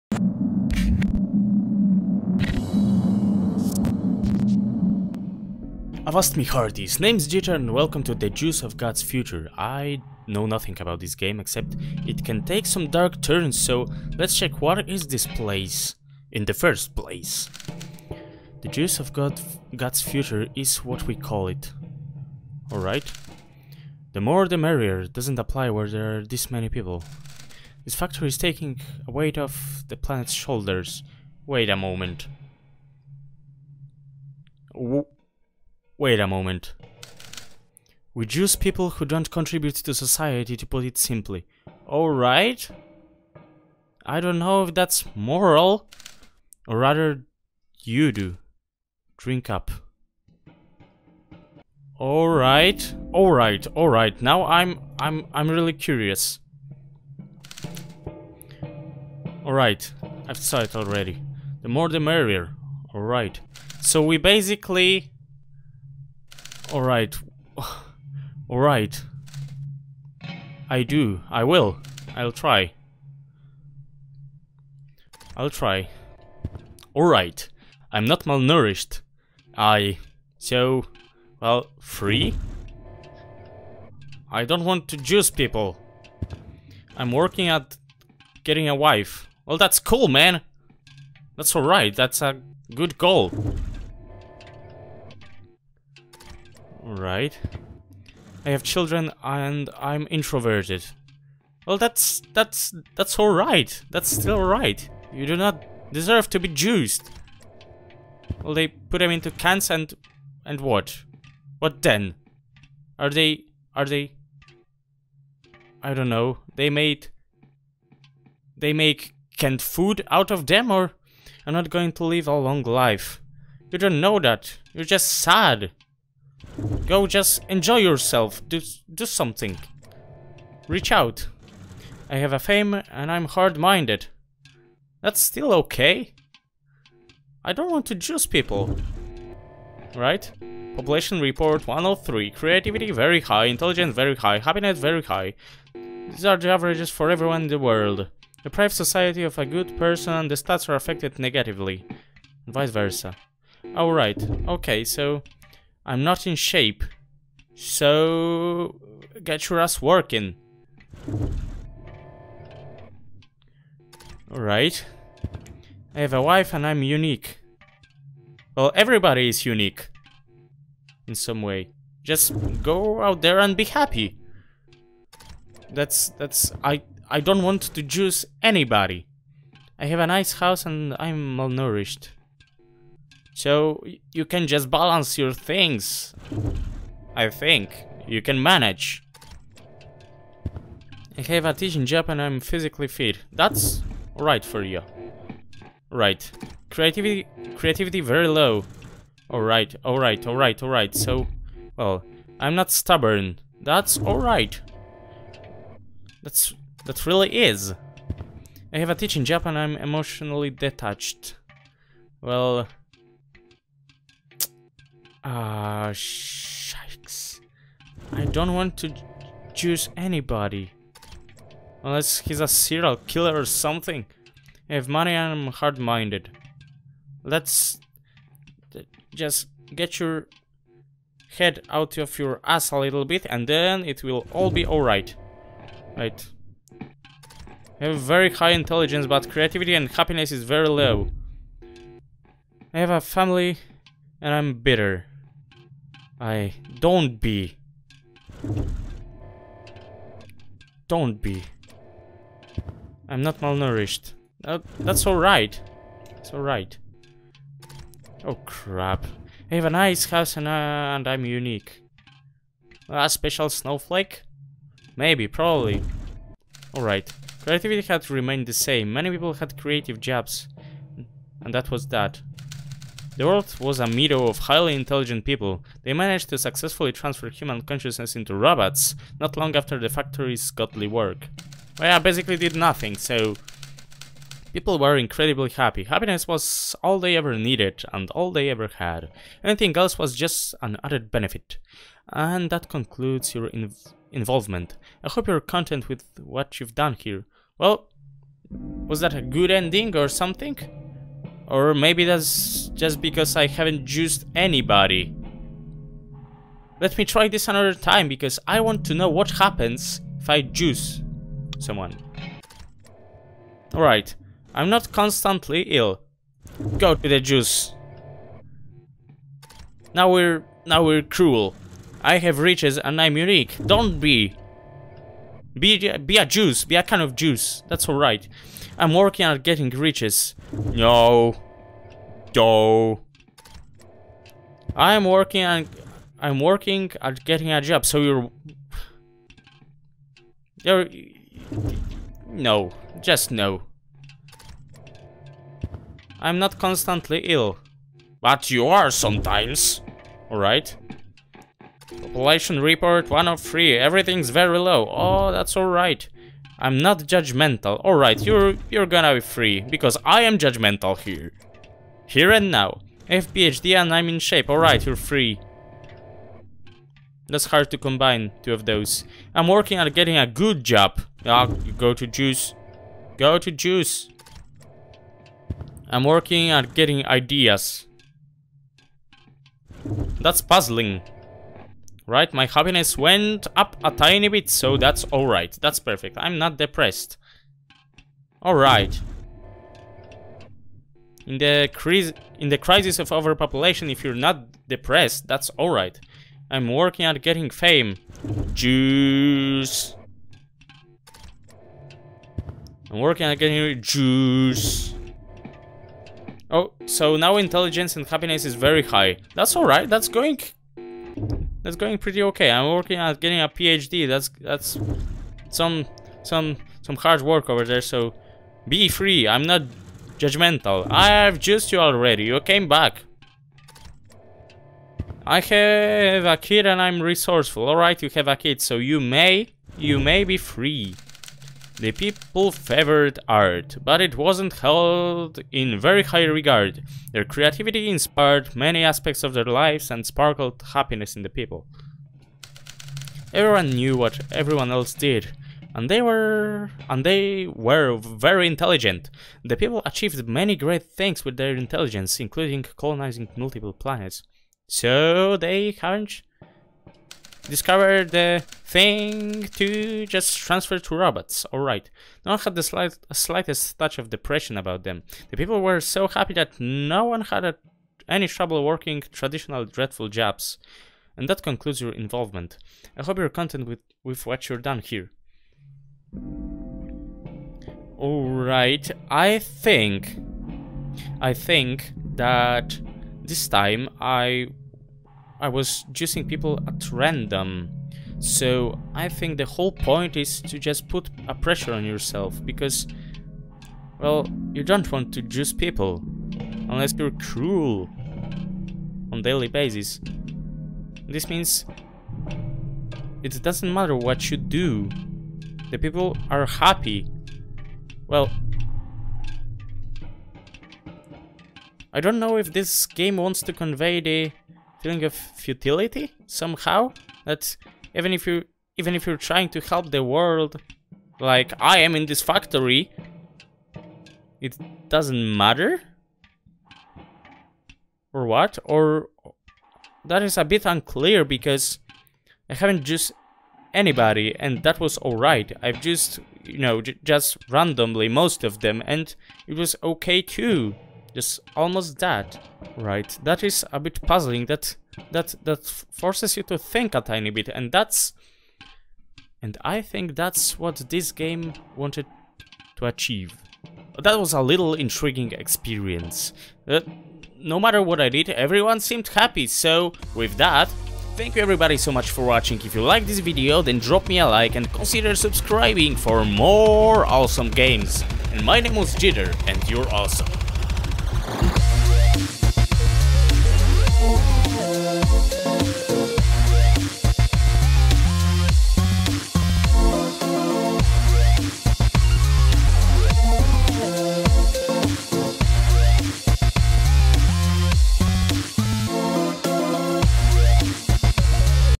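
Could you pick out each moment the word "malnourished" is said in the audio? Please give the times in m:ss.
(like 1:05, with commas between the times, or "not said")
1:18, 3:01, 4:13.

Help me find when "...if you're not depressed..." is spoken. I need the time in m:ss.
6:33.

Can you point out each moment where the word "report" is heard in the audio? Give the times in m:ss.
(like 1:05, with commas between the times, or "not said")
2:21, 5:52.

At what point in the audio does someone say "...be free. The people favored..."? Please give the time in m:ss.
7:10.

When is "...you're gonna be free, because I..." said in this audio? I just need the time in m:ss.
5:58.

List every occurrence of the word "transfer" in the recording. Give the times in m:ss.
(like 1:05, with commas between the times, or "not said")
4:36, 7:40.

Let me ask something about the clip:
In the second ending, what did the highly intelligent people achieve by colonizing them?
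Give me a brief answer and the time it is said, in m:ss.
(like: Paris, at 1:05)
multiple planets, at 7:33.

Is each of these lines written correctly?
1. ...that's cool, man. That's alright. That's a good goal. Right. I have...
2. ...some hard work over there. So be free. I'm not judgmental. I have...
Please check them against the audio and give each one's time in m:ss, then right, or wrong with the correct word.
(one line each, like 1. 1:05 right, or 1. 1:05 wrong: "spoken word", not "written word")
1. 1:29 right
2. 6:56 right.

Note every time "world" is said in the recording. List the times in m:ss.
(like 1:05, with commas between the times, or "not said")
2:27, 4:33, 8:40.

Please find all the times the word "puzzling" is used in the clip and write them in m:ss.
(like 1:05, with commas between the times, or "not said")
6:20, 9:04.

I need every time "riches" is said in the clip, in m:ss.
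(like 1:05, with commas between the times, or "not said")
5:22, 5:29.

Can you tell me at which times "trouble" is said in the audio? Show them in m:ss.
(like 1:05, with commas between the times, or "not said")
7:48.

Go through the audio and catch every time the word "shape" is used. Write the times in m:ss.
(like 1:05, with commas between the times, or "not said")
2:36, 6:04.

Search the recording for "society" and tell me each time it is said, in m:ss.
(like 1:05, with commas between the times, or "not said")
0:39, 2:28.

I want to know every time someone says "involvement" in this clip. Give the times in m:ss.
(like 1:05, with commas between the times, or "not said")
4:54, 7:51.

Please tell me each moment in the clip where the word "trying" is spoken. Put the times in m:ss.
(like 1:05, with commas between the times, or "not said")
8:39.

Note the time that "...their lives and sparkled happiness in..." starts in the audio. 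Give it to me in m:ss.
7:19.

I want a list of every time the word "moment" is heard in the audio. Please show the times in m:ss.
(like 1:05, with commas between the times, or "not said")
0:31, 0:36.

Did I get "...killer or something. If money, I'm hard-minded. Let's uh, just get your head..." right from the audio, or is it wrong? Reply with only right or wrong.
right.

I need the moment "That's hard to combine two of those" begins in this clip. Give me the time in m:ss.
6:07.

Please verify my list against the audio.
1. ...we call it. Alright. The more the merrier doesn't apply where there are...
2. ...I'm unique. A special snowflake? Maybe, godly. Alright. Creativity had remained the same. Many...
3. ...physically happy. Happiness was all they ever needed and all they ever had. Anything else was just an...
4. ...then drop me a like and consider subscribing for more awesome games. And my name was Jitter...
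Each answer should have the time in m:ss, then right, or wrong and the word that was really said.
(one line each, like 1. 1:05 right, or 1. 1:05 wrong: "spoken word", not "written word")
1. 0:21 right
2. 4:21 wrong: "probably", not "godly"
3. 4:44 wrong: "incredibly", not "physically"
4. 9:23 right.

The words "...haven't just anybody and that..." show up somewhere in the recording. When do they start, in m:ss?
8:52.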